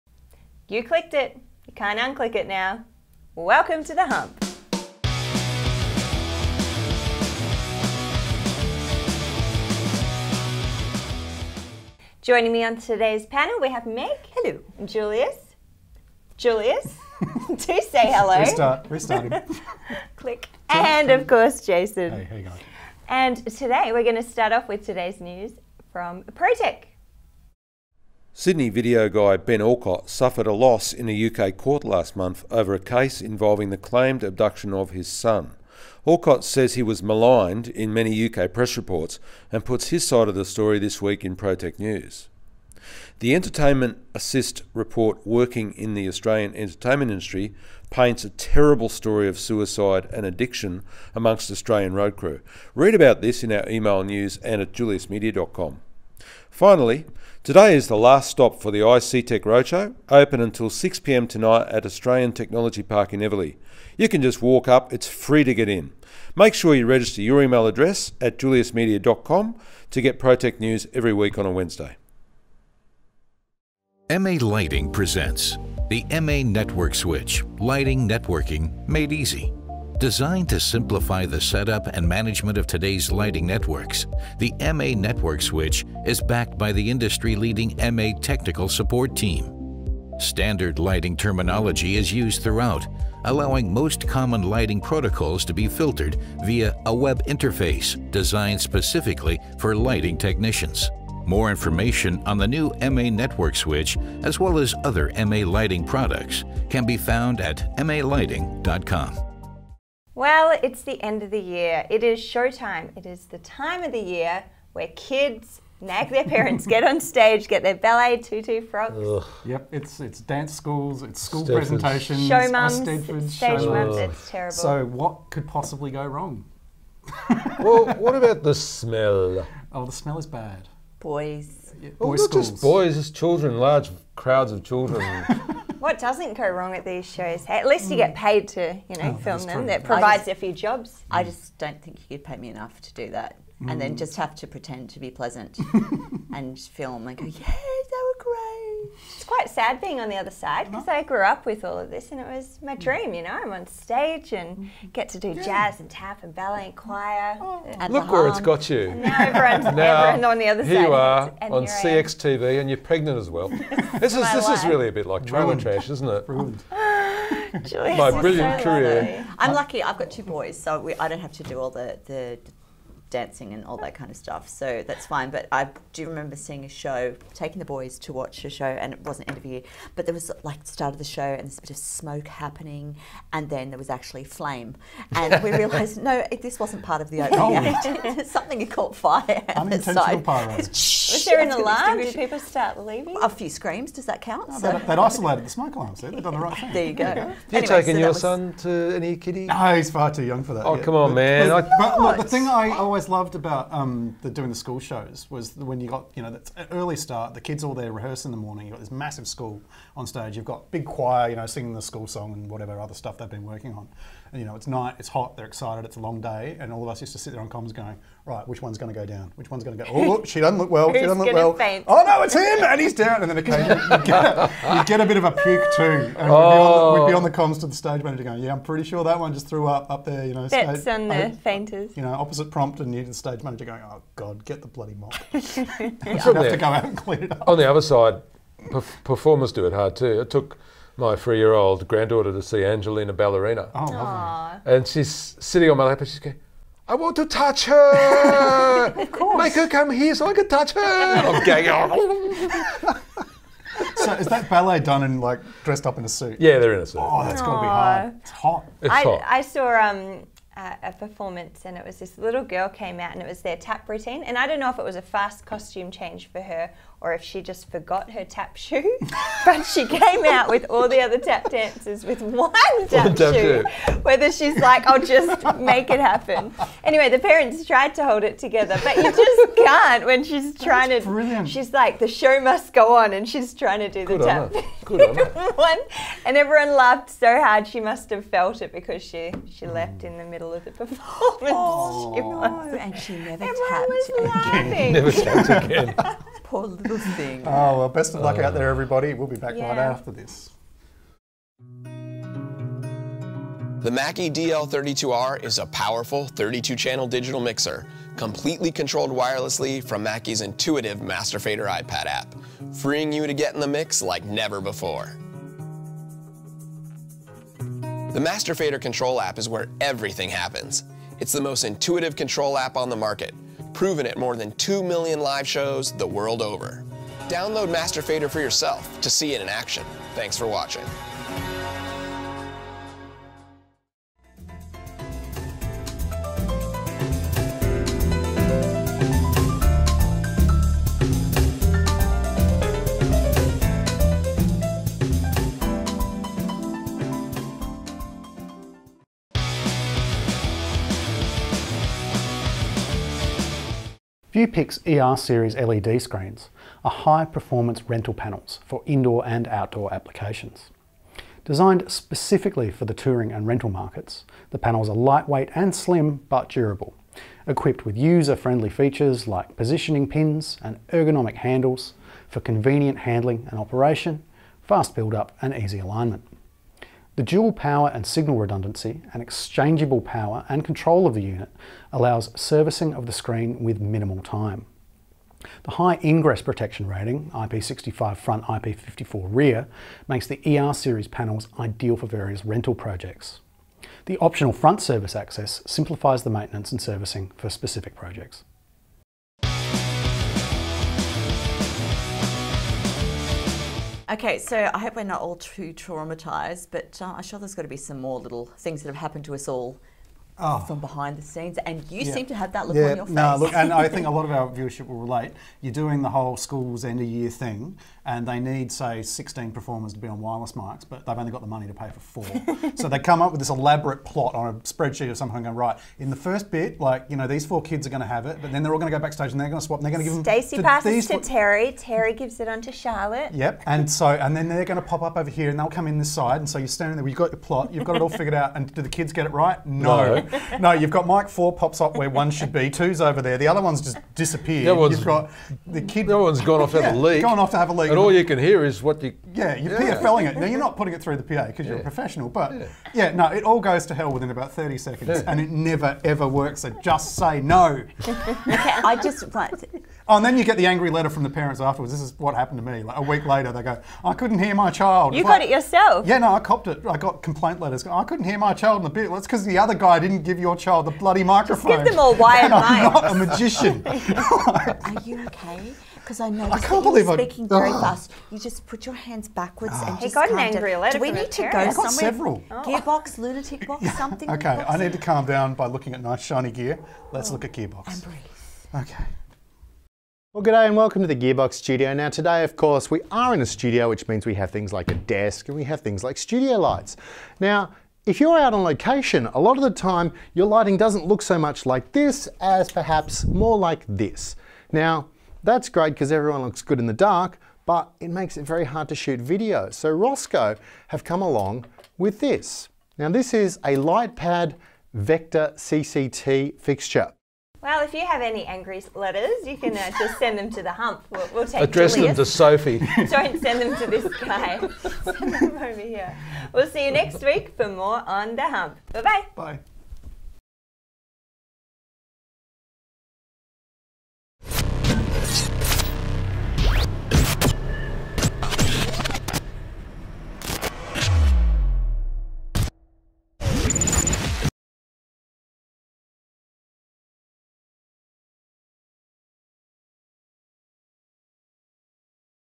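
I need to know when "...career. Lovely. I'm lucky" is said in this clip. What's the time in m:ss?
2:48.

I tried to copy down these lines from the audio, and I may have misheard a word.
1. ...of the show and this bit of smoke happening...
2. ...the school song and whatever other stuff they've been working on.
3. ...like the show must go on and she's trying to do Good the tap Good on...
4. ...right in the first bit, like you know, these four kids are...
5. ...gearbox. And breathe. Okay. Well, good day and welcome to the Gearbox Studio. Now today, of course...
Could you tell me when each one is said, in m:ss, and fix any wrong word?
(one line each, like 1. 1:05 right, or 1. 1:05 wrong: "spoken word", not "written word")
1. 3:00 right
2. 3:31 right
3. 4:41 right
4. 7:05 right
5. 8:07 right.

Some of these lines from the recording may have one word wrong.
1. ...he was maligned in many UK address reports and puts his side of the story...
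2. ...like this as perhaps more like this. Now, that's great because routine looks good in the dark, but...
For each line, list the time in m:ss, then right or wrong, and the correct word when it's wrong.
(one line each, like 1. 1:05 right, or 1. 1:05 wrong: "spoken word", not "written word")
1. 0:36 wrong: "press", not "address"
2. 8:21 wrong: "everyone", not "routine".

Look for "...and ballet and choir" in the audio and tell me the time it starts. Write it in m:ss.
2:36.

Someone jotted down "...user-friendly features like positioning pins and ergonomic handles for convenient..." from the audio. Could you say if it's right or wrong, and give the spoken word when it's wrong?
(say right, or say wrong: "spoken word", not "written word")
right.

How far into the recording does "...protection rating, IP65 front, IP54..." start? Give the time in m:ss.
6:26.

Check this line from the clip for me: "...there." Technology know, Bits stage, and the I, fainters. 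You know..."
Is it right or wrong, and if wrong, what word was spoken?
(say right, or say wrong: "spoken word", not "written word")
wrong: "You", not "Technology".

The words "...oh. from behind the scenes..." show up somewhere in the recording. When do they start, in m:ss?
6:50.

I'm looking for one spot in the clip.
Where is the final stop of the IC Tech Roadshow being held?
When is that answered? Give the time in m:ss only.
1:01.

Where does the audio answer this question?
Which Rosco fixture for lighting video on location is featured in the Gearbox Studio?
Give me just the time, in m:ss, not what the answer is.
8:33.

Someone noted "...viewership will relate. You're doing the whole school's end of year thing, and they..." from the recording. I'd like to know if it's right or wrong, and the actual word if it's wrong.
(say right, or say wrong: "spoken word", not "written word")
right.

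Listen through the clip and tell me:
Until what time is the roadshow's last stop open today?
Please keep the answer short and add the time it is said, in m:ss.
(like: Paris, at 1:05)
6pm, at 1:00.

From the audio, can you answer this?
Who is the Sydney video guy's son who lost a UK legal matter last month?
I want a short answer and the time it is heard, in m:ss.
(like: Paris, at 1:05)
Ben Alcott, at 0:29.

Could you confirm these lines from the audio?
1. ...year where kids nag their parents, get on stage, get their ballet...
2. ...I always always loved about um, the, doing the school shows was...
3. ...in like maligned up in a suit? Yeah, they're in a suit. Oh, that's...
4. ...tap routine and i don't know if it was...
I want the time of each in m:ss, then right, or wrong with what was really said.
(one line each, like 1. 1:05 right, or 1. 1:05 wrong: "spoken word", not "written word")
1. 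1:53 right
2. 3:22 right
3. 4:15 wrong: "dressed", not "maligned"
4. 4:23 right.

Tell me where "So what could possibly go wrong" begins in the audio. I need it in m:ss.
2:04.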